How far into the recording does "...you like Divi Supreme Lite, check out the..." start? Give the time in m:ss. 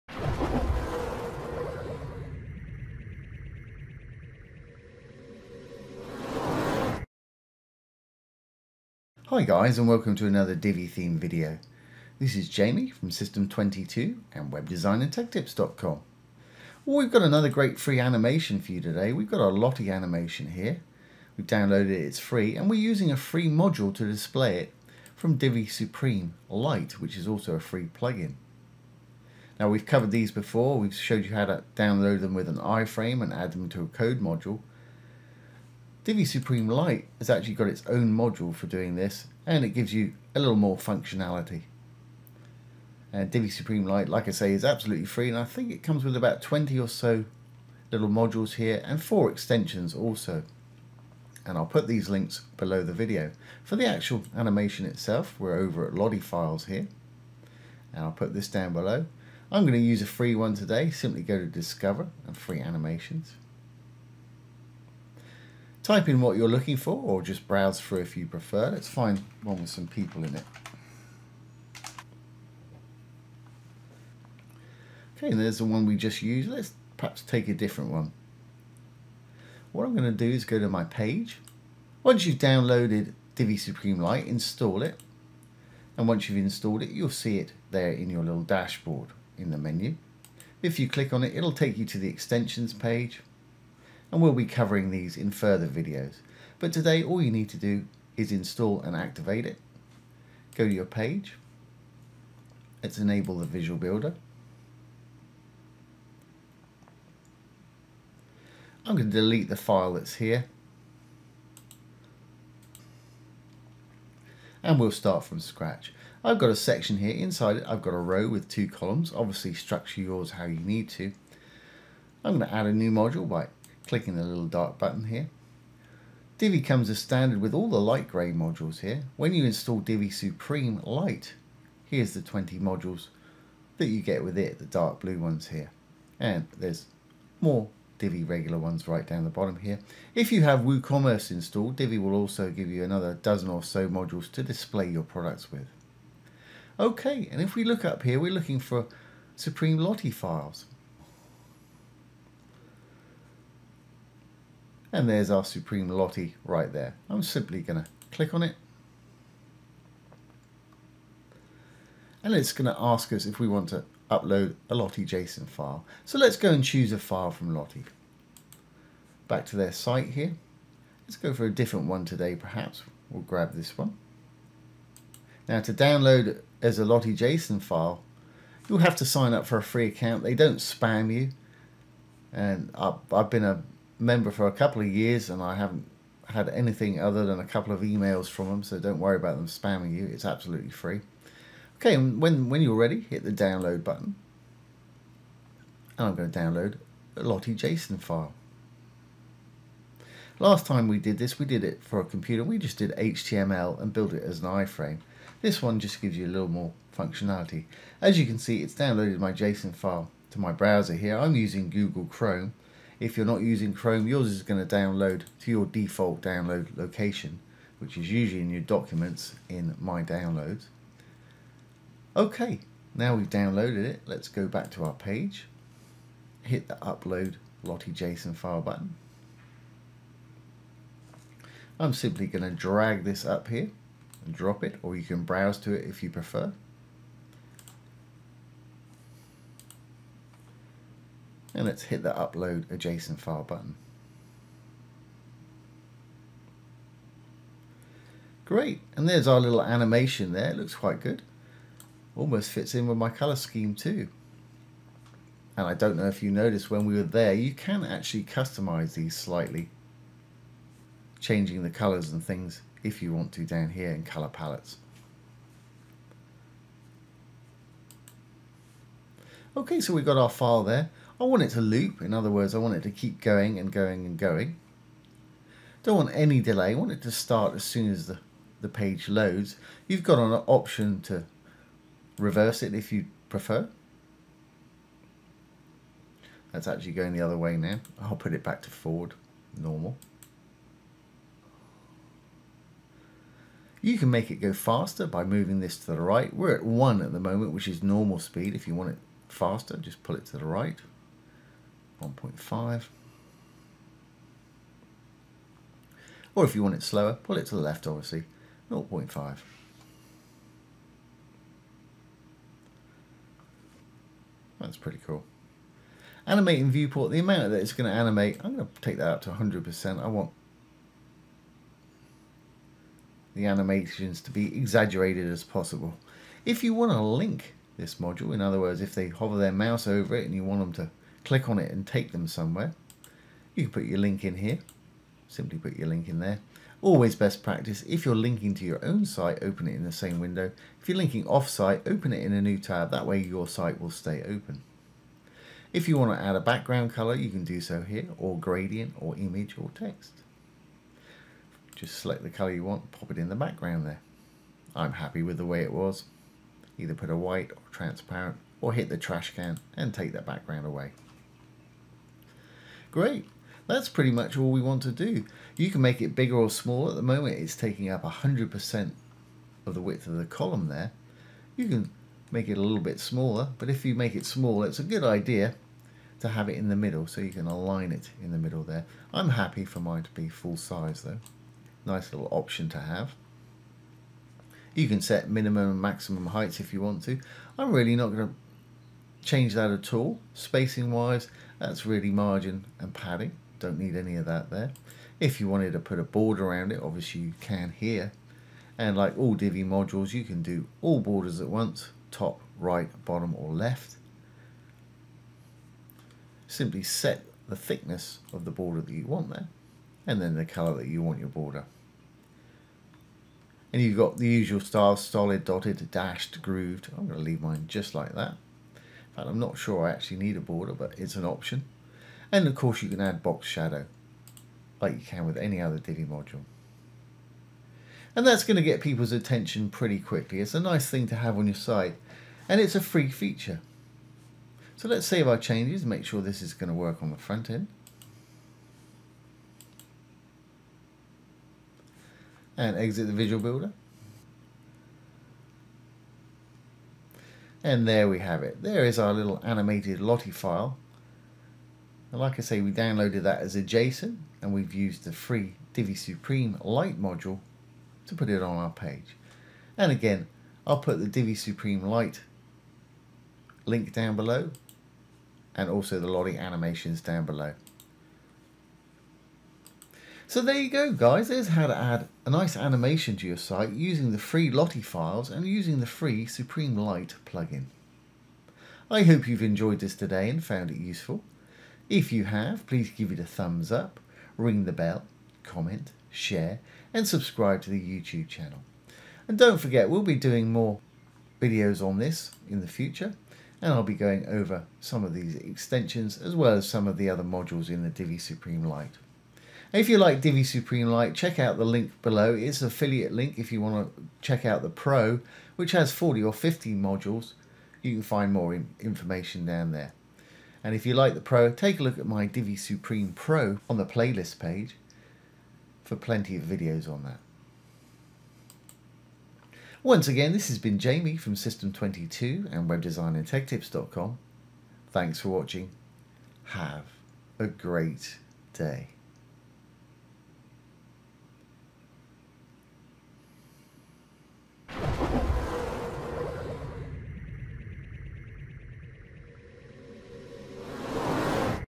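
8:19.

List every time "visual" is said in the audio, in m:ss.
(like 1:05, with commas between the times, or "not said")
1:43, 7:23.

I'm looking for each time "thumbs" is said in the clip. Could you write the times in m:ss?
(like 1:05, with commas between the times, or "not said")
8:03.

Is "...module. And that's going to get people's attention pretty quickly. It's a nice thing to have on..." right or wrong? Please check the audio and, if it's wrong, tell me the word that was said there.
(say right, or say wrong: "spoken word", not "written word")
right.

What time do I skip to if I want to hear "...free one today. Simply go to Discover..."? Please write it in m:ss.
1:00.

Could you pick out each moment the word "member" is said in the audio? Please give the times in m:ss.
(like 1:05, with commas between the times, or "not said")
3:04.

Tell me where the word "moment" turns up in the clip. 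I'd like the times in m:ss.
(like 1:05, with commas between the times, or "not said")
4:57, 6:07.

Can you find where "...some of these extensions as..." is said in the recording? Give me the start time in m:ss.
8:14.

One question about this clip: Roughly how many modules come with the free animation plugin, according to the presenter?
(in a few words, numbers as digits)
20.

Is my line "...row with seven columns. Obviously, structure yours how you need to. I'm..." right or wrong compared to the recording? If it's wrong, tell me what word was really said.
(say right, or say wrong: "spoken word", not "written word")
wrong: "two", not "seven".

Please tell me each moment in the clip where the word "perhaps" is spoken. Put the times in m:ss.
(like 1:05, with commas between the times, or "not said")
1:16, 2:52.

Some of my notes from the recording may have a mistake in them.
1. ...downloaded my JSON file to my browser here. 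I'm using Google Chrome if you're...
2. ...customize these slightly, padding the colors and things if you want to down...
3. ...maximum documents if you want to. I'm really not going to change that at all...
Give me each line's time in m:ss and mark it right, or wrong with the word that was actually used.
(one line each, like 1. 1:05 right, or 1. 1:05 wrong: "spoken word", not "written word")
1. 3:28 right
2. 4:18 wrong: "changing", not "padding"
3. 6:25 wrong: "heights", not "documents".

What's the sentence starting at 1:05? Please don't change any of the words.
Type in what you're looking for or just browse through if you prefer.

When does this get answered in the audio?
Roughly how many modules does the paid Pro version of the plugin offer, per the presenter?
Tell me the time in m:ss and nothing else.
8:25.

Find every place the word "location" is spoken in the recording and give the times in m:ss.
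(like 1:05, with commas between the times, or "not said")
3:36.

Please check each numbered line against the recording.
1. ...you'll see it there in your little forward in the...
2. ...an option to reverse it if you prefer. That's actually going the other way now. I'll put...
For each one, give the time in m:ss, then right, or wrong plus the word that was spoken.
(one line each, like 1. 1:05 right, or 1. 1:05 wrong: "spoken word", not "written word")
1. 1:26 wrong: "dashboard", not "forward"
2. 4:40 right.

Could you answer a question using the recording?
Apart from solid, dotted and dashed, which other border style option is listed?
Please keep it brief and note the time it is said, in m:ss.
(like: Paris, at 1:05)
grooved, at 6:56.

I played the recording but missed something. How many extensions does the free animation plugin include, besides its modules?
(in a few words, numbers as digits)
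4.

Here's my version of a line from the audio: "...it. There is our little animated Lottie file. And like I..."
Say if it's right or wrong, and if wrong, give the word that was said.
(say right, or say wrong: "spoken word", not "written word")
right.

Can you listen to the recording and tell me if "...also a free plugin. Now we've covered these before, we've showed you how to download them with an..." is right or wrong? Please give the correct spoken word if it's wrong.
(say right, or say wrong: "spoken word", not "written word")
right.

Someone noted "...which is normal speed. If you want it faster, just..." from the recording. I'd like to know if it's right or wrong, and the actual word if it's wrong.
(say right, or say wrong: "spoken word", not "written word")
right.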